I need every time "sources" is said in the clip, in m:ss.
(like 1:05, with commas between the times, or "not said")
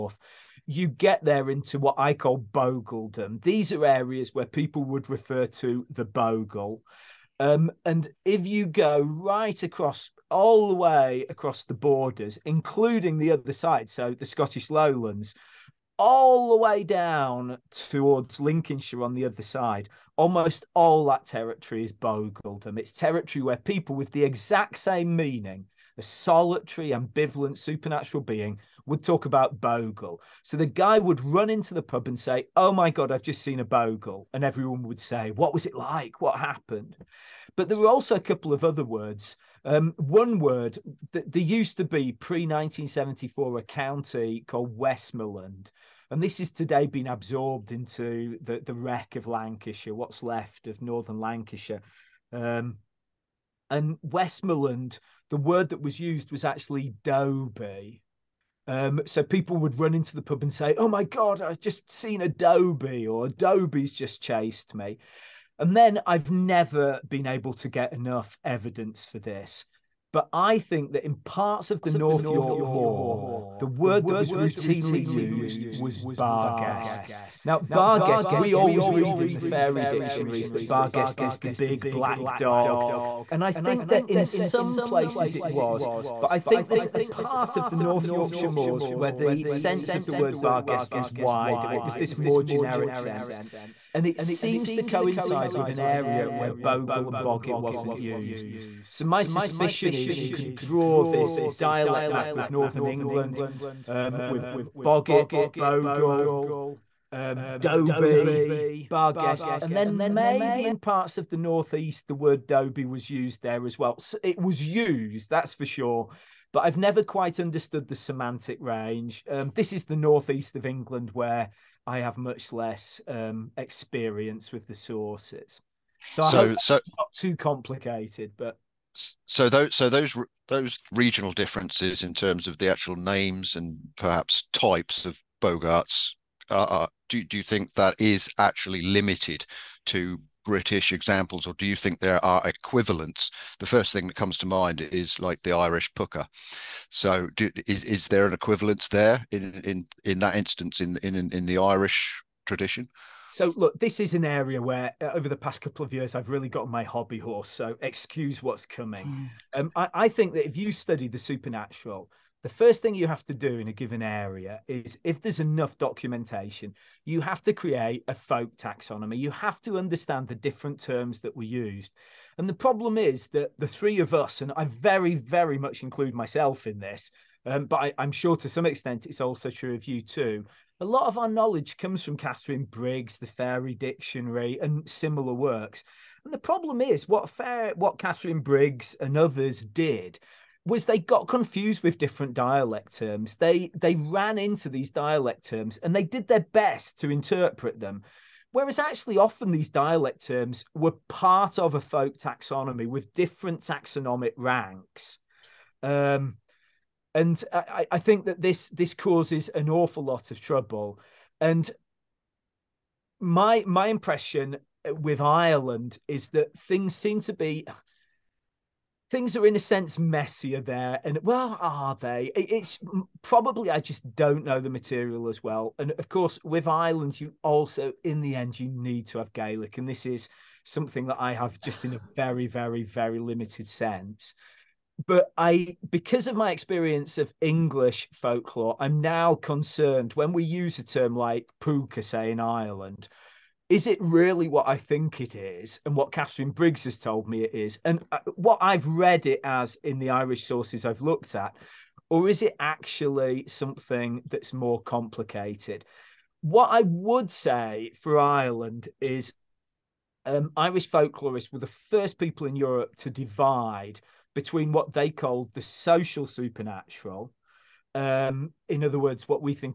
2:04, 4:10.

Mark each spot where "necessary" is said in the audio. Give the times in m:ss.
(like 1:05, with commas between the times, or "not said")
not said.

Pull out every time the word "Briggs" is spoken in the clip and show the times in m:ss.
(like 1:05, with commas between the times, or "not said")
3:02, 3:08, 4:06.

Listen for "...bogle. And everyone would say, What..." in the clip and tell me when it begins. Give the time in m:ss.
0:33.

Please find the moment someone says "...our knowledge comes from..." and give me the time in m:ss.
3:01.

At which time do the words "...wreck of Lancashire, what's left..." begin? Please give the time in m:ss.
0:48.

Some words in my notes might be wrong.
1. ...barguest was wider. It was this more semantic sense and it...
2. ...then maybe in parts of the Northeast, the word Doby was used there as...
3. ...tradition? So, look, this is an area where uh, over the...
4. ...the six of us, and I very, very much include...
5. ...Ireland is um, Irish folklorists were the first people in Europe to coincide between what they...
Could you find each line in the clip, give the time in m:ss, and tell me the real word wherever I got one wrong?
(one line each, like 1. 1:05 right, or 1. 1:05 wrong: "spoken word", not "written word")
1. 1:30 wrong: "generic", not "semantic"
2. 1:49 right
3. 2:32 right
4. 2:53 wrong: "three", not "six"
5. 4:18 wrong: "divide", not "coincide".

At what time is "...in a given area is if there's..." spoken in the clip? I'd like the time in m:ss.
2:43.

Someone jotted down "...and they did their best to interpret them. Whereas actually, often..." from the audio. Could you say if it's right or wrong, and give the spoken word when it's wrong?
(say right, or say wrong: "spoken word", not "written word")
right.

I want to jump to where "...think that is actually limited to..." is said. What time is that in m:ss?
2:17.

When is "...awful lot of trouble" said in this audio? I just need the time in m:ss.
3:29.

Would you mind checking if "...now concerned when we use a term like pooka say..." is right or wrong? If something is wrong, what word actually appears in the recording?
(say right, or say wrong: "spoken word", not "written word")
right.